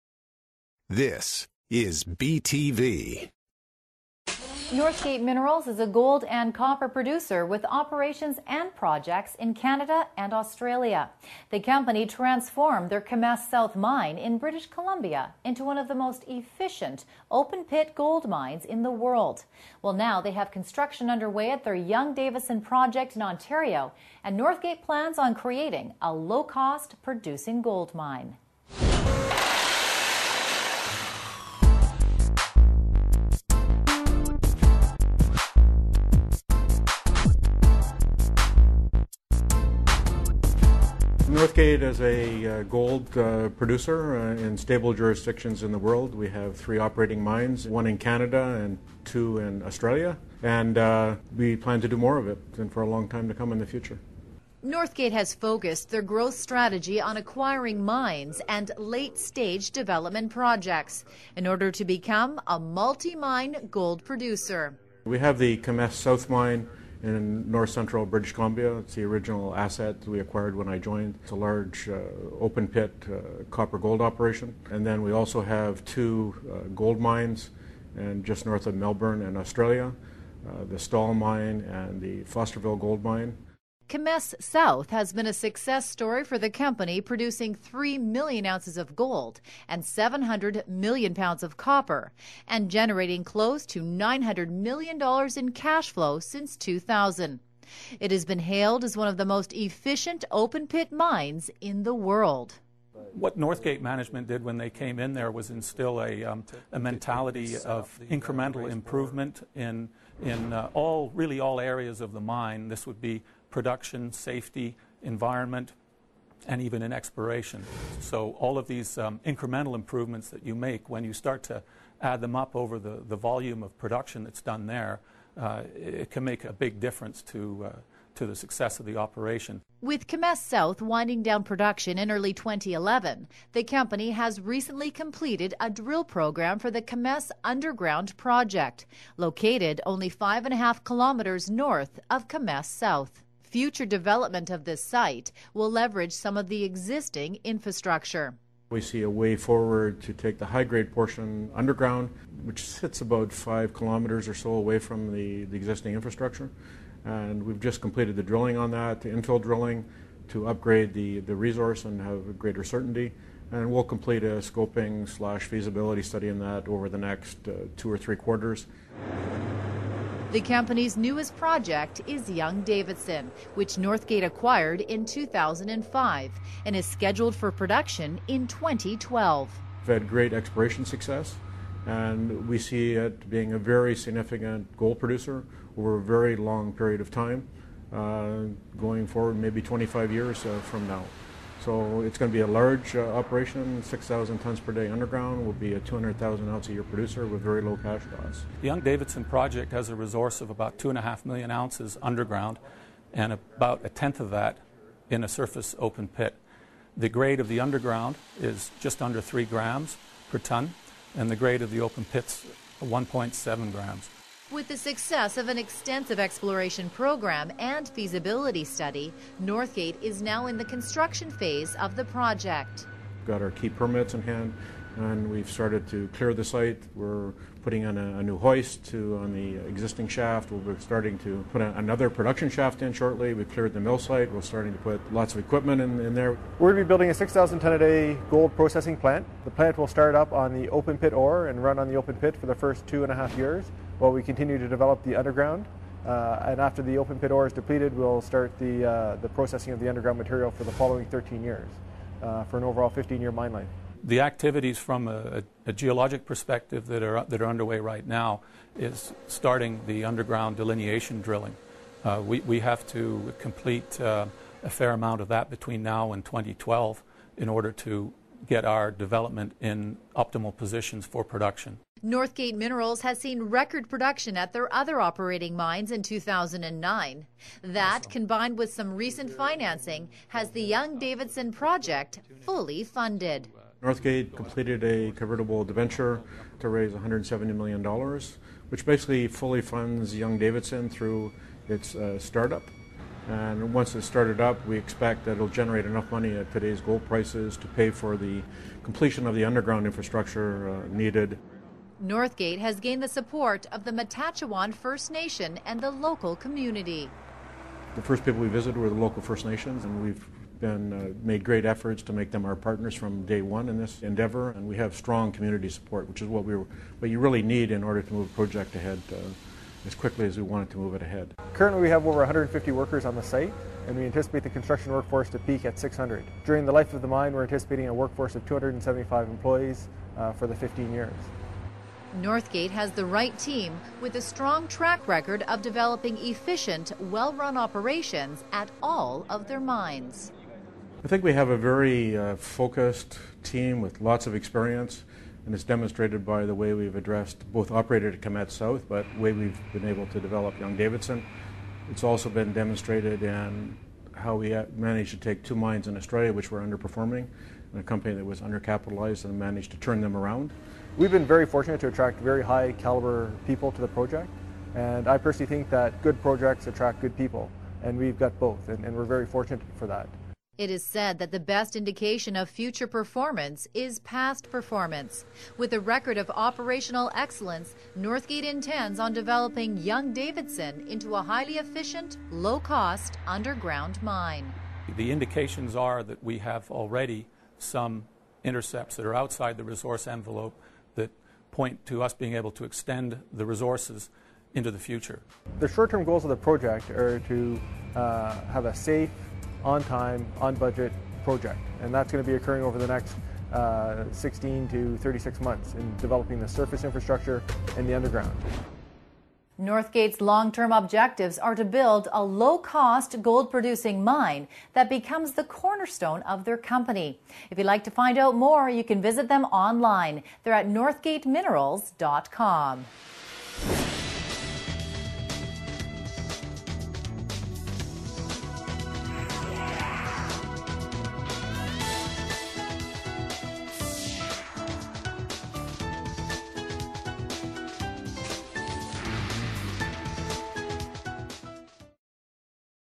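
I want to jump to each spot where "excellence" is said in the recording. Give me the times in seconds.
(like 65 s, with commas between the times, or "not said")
377 s.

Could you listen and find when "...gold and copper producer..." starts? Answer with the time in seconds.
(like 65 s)
5 s.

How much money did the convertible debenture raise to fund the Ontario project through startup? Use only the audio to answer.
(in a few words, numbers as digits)
$170 million.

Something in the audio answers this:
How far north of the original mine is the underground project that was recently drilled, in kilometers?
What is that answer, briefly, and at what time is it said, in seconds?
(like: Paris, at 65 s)
5.5 kilometers, at 140 s.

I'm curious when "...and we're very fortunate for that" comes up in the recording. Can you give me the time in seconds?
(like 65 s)
368 s.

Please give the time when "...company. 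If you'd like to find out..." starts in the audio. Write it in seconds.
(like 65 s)
416 s.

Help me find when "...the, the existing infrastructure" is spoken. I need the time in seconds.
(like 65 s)
155 s.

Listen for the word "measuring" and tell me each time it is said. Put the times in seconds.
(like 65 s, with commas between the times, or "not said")
not said.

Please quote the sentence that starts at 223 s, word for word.
We've Got our key permits in hand and we've started to clear the site.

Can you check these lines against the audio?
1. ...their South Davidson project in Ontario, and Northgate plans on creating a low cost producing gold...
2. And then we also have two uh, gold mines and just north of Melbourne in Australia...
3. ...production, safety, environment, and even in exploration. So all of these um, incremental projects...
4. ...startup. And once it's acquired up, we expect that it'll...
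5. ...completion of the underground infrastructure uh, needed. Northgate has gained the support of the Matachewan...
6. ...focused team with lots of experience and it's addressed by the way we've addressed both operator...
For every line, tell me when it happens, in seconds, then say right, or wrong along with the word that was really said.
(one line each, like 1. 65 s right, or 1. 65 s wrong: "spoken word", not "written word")
1. 21 s wrong: "Young", not "South"
2. 74 s right
3. 113 s wrong: "improvements", not "projects"
4. 292 s wrong: "started", not "acquired"
5. 298 s right
6. 342 s wrong: "demonstrated", not "addressed".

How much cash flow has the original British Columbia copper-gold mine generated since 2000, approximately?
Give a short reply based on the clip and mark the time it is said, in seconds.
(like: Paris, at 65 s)
$900 million, at 93 s.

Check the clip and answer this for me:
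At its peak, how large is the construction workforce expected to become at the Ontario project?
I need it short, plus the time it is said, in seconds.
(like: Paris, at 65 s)
600, at 325 s.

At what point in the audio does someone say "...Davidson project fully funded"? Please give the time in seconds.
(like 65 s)
280 s.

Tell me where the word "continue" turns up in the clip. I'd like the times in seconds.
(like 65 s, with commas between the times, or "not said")
244 s.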